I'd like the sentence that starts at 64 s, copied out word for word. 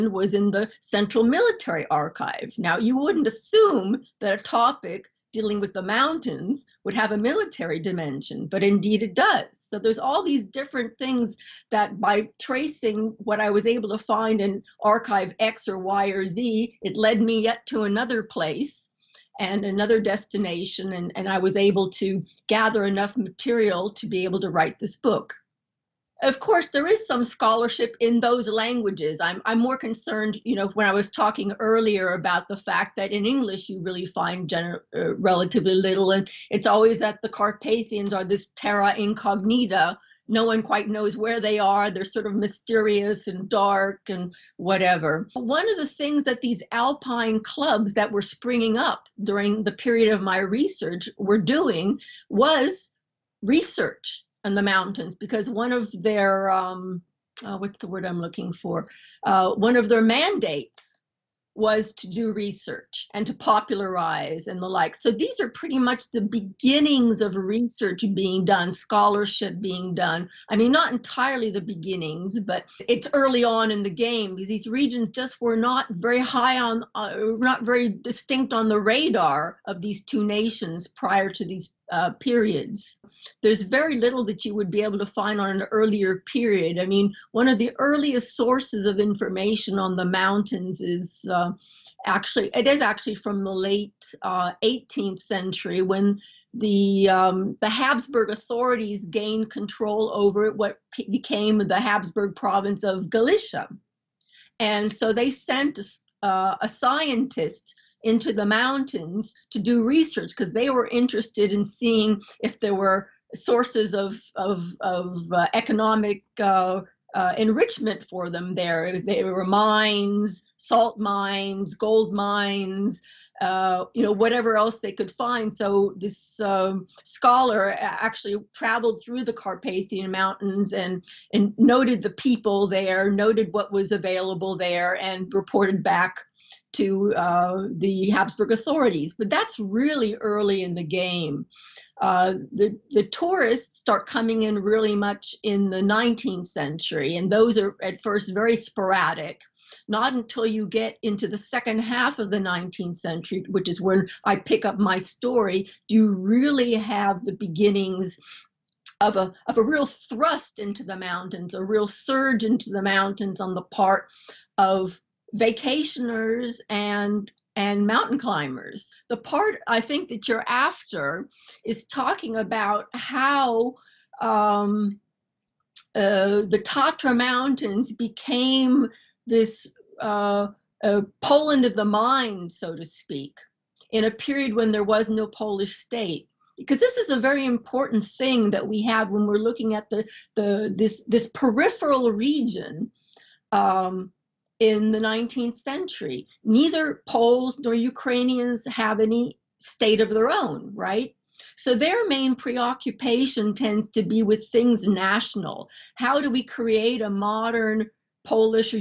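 So these are pretty much the beginnings of research being done, scholarship being done.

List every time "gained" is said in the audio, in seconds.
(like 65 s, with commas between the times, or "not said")
99 s.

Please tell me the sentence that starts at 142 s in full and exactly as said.
Uh, the, the tourists start coming in really much in the 19th century, and those are at first very sporadic.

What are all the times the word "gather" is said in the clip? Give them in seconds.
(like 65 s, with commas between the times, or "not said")
22 s.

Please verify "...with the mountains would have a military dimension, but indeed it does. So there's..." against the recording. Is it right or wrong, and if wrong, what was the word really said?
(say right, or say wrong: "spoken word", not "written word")
right.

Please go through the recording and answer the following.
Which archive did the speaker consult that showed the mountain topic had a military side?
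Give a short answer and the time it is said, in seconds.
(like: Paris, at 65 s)
Central Military Archive, at 0 s.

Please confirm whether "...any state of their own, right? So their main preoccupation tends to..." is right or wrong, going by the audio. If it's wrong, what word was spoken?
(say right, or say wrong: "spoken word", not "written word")
right.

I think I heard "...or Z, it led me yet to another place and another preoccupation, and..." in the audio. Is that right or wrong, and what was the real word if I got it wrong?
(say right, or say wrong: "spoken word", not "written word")
wrong: "destination", not "preoccupation".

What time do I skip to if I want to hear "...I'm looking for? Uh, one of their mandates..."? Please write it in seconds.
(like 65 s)
58 s.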